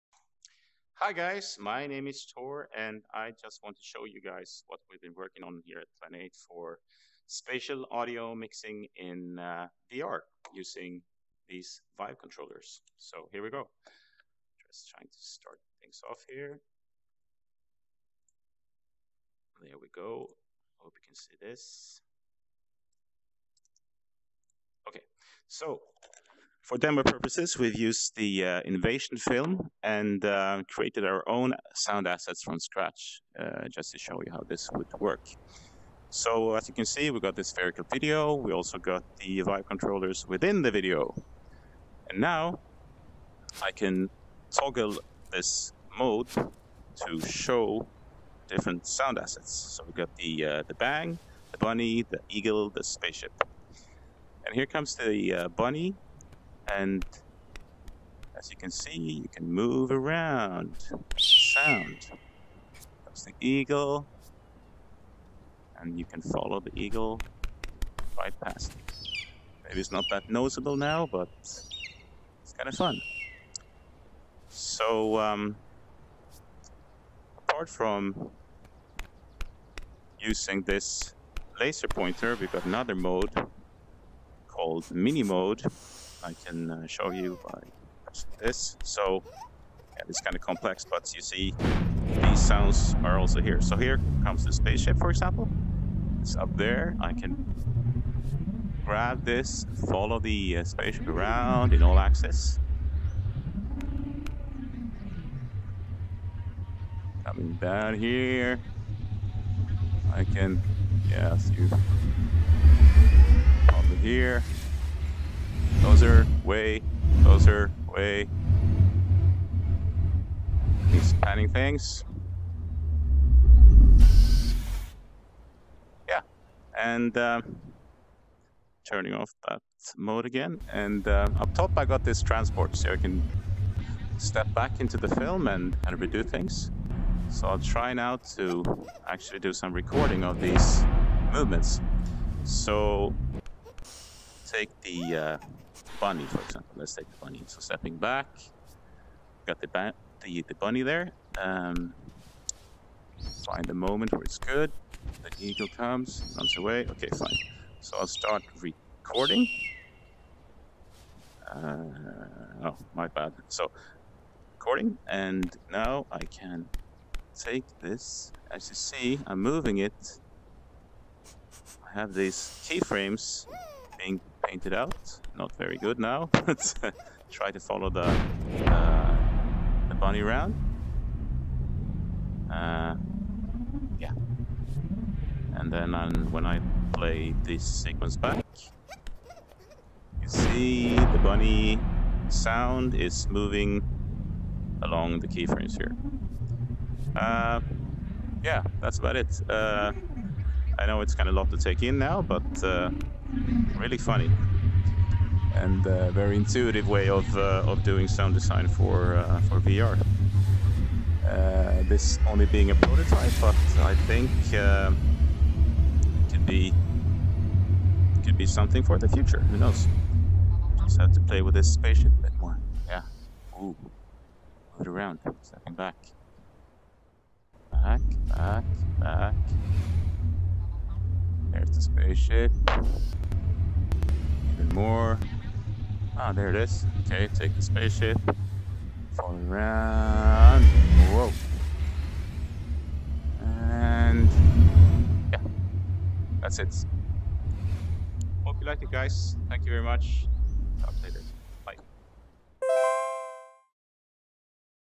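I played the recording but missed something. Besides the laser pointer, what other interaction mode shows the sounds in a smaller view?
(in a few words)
mini mode.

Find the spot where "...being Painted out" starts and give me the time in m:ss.
2:53.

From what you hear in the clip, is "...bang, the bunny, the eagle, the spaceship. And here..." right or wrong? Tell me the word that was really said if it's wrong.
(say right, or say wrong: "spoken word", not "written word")
right.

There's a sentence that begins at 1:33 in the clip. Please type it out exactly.
So here comes the spaceship, for example.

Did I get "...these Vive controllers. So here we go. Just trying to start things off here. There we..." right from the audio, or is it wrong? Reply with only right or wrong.
right.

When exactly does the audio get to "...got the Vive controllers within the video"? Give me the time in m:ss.
0:38.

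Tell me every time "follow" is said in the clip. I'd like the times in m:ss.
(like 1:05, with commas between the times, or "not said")
1:06, 1:39, 2:57.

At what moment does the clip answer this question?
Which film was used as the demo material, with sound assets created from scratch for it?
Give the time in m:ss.
0:28.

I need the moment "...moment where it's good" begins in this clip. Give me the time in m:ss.
2:33.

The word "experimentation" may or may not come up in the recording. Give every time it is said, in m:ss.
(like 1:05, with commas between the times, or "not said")
not said.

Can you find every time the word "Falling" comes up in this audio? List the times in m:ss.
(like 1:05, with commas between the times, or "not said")
3:59.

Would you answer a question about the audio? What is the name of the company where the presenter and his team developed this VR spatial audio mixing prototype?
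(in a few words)
Plan 8.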